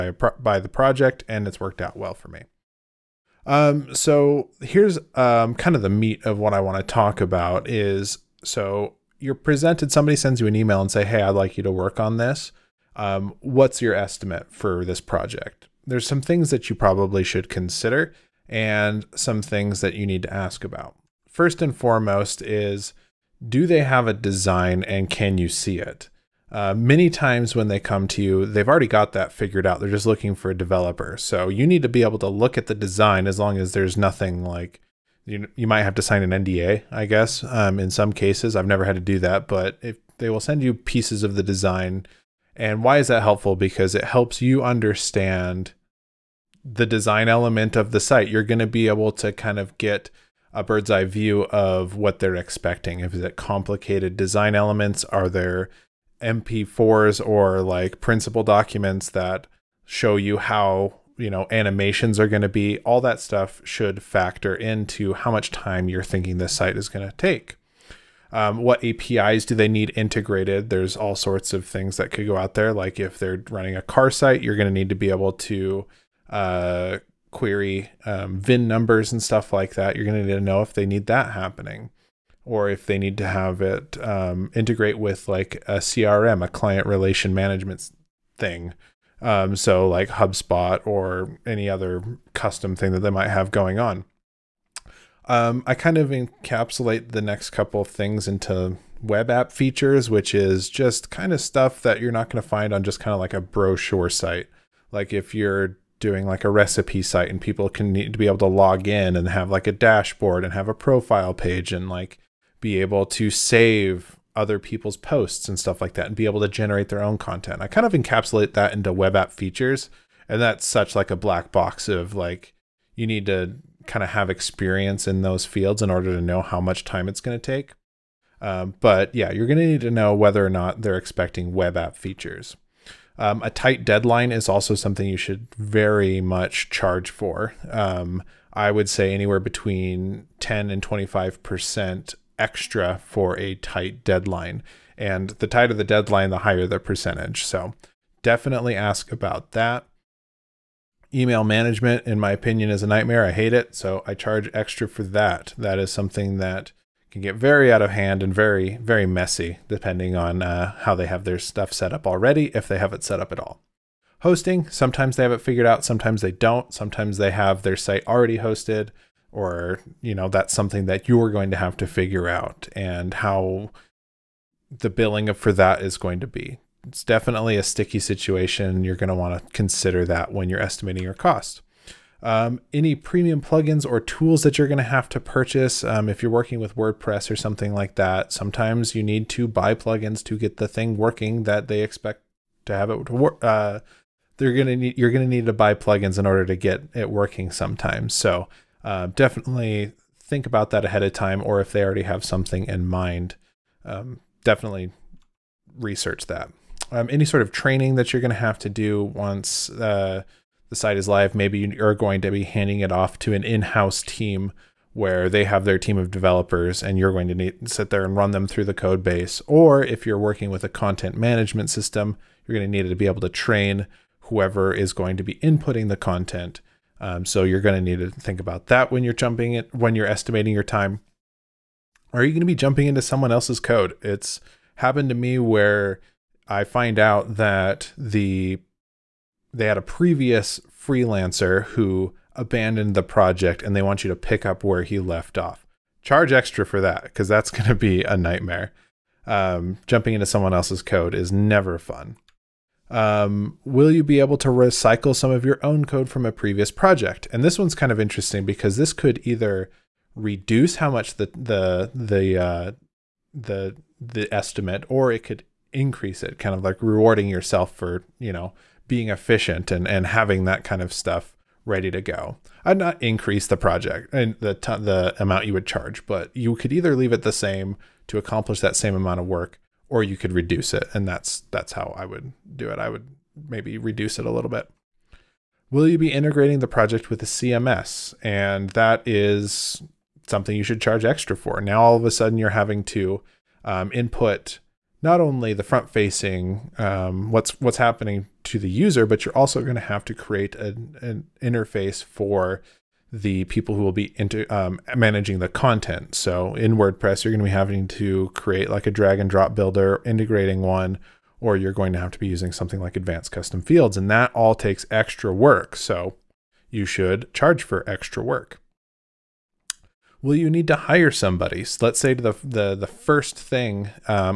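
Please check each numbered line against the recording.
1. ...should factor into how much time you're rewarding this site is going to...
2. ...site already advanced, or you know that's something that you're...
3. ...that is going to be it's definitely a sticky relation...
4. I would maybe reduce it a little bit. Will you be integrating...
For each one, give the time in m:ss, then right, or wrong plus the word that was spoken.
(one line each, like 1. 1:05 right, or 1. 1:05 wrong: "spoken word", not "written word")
1. 1:03 wrong: "thinking", not "rewarding"
2. 2:47 wrong: "hosted", not "advanced"
3. 2:55 wrong: "situation", not "relation"
4. 4:42 right.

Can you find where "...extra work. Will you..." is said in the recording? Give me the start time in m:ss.
5:17.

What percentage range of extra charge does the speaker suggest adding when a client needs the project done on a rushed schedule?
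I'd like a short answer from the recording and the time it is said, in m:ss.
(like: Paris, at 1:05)
10 to 25%, at 2:19.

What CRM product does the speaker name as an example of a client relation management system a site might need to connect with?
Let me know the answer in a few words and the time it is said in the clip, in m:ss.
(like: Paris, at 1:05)
HubSpot, at 1:30.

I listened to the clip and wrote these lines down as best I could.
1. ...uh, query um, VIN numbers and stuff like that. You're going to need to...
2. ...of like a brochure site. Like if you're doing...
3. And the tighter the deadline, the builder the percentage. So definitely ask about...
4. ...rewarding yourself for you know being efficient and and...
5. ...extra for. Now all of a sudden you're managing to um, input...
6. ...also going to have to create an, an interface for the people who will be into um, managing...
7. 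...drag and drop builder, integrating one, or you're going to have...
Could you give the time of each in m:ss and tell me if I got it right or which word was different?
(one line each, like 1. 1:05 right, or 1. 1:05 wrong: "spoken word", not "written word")
1. 1:16 right
2. 1:43 right
3. 2:24 wrong: "higher", not "builder"
4. 4:26 right
5. 4:51 wrong: "having", not "managing"
6. 4:59 right
7. 5:08 right.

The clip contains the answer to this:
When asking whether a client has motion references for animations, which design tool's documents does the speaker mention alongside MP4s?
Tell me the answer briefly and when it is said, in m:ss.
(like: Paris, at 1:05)
Principle, at 0:57.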